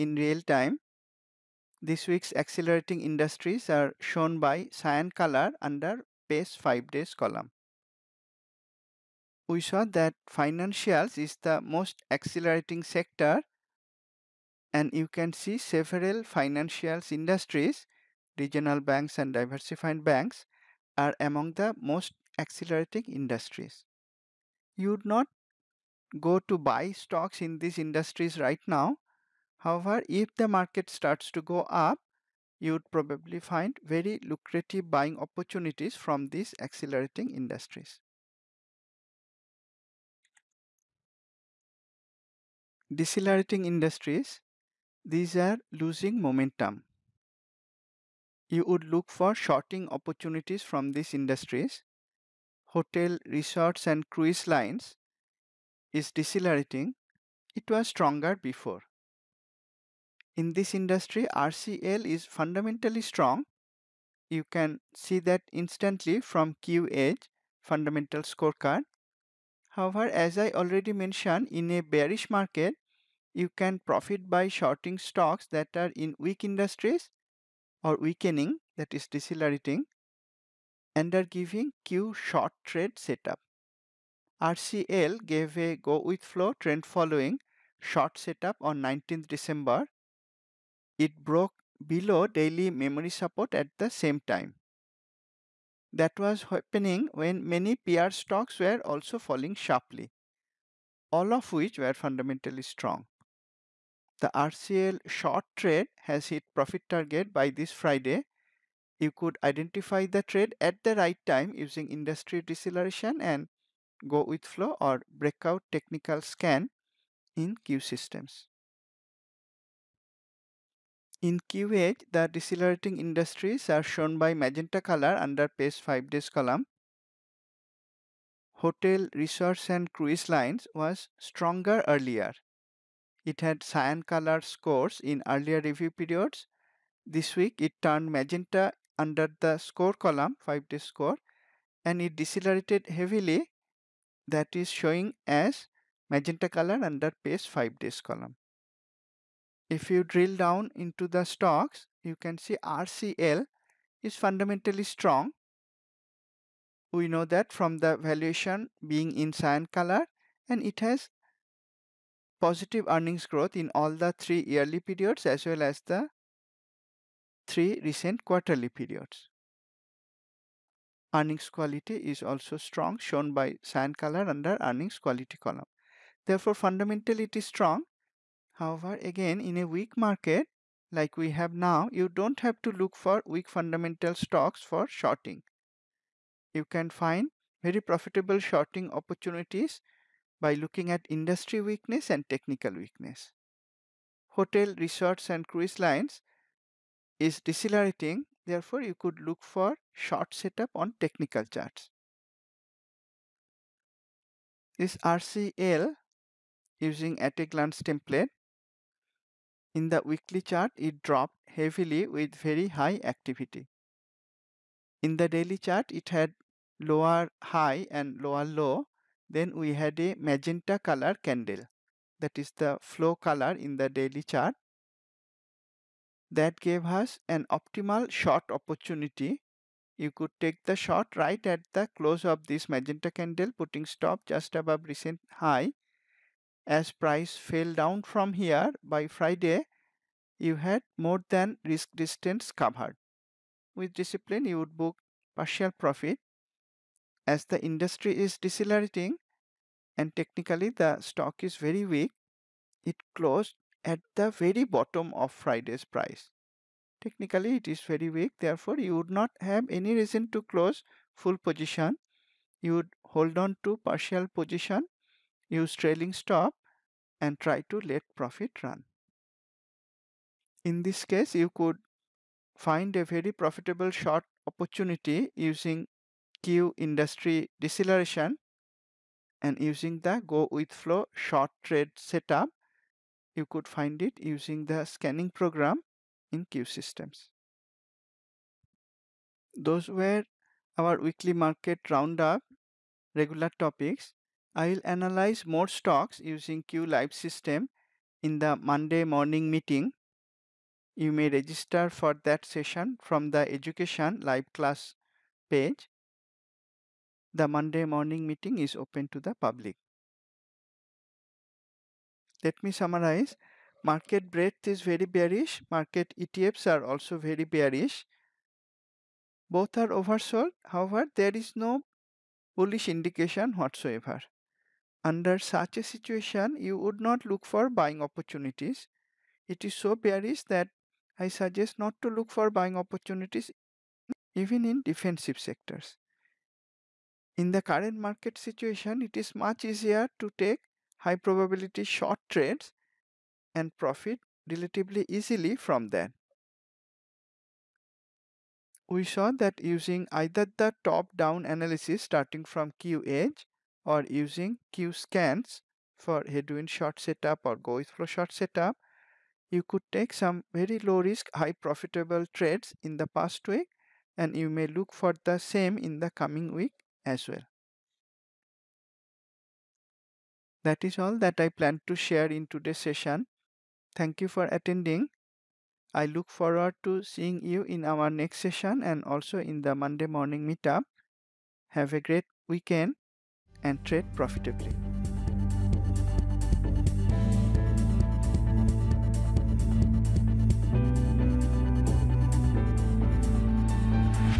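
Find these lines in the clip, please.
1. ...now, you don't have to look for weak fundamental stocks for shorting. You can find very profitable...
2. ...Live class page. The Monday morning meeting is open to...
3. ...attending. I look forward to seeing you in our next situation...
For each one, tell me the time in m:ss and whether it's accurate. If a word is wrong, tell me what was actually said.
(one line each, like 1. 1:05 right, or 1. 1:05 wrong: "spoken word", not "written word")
1. 3:01 right
2. 5:04 right
3. 6:14 wrong: "session", not "situation".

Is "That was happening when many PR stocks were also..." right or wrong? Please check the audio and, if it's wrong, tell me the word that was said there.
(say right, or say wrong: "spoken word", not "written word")
right.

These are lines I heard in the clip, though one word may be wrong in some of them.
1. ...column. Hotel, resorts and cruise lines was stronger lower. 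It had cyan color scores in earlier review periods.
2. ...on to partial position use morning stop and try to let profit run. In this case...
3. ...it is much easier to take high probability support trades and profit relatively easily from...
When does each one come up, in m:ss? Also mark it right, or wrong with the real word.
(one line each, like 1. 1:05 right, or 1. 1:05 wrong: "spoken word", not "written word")
1. 2:06 wrong: "earlier", not "lower"
2. 4:23 wrong: "trailing", not "morning"
3. 5:39 wrong: "short", not "support".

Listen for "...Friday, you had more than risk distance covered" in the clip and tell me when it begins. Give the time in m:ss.
3:59.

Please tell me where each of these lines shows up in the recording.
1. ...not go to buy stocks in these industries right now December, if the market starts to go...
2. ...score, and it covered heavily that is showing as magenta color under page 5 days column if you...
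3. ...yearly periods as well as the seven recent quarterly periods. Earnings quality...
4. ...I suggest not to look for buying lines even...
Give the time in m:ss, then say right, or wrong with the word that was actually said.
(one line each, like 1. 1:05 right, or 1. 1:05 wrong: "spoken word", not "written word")
1. 0:25 wrong: "However", not "December"
2. 2:20 wrong: "decelerated", not "covered"
3. 2:44 wrong: "three", not "seven"
4. 5:31 wrong: "opportunities", not "lines".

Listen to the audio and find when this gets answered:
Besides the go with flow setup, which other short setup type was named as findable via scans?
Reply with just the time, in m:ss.
5:56.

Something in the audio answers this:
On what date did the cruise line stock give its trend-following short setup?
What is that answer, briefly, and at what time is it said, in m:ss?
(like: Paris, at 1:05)
19th December, at 1:28.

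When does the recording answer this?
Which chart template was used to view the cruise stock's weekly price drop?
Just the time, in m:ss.
3:27.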